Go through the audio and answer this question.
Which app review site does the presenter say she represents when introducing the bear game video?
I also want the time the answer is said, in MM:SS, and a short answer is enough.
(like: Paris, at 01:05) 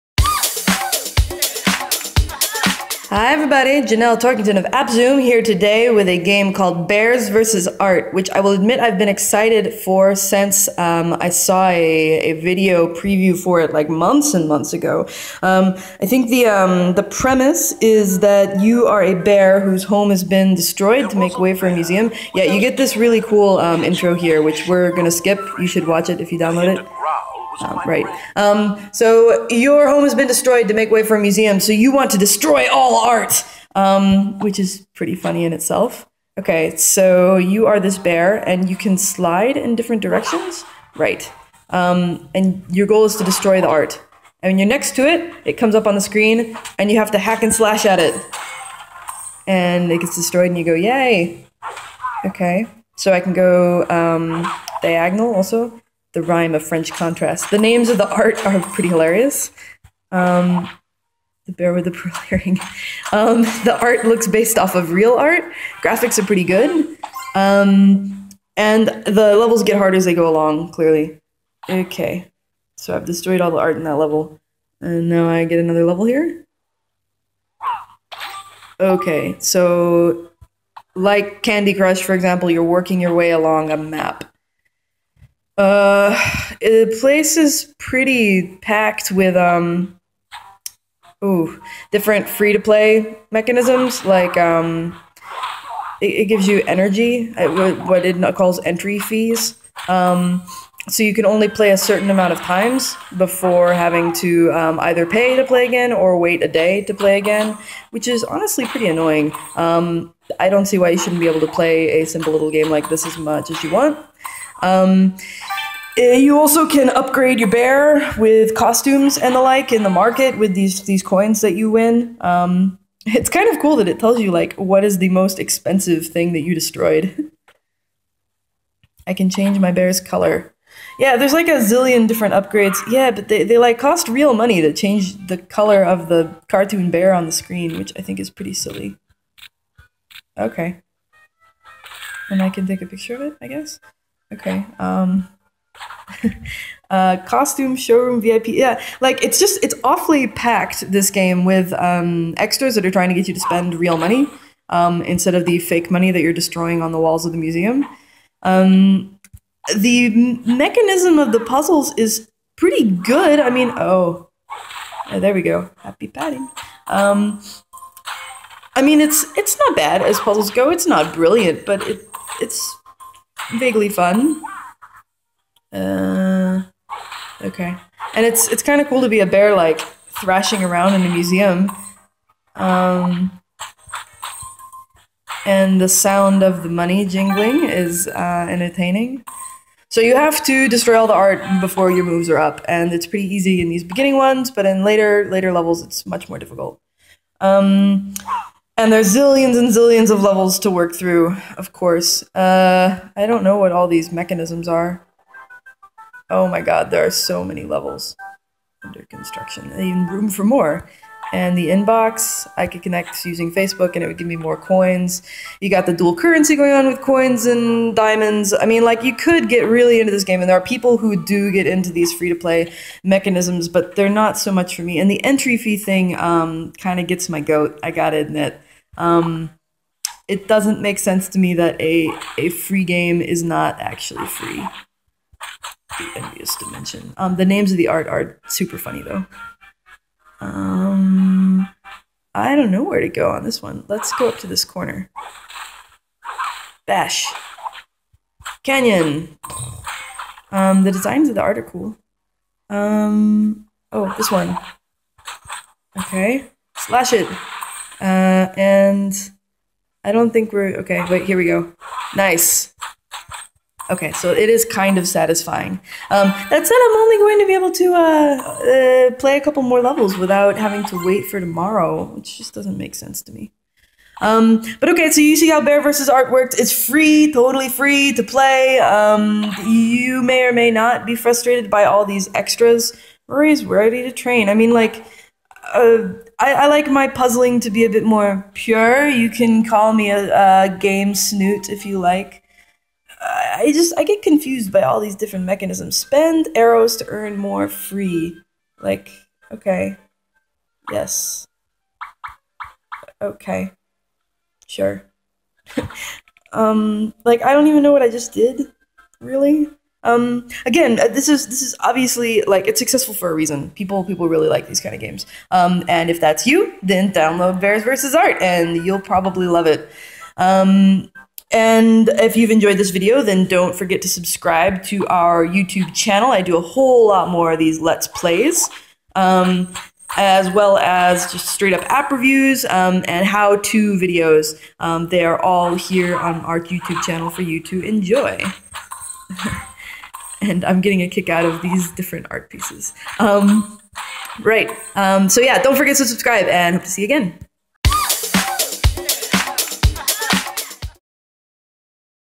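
Appszoom, at 00:04.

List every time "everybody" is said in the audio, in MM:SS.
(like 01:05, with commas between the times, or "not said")
00:03.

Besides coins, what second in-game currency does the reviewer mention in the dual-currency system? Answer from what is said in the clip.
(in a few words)
Diamonds.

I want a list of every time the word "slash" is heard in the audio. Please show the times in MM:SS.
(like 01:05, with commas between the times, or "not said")
00:47, 04:16.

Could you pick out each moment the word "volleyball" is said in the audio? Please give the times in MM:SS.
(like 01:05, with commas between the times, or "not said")
not said.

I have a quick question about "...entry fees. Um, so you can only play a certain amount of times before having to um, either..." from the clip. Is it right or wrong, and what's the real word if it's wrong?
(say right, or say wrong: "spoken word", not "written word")
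right.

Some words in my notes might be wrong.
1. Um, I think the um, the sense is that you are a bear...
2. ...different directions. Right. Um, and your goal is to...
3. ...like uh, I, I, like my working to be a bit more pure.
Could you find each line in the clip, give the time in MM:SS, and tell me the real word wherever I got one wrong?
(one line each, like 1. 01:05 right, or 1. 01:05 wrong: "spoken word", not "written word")
1. 00:15 wrong: "premise", not "sense"
2. 00:39 right
3. 04:44 wrong: "puzzling", not "working".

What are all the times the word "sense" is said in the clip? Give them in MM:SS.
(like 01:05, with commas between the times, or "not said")
03:50, 04:32.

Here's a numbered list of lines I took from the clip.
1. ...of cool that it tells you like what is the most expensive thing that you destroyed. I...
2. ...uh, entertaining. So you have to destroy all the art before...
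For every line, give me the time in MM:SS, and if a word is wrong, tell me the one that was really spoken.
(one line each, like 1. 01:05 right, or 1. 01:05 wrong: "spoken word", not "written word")
1. 02:03 right
2. 03:08 right.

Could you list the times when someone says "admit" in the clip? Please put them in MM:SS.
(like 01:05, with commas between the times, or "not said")
00:08, 03:48.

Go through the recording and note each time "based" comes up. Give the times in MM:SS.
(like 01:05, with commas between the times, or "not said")
01:04.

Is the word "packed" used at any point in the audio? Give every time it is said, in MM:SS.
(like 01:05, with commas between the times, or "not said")
01:28, 02:30.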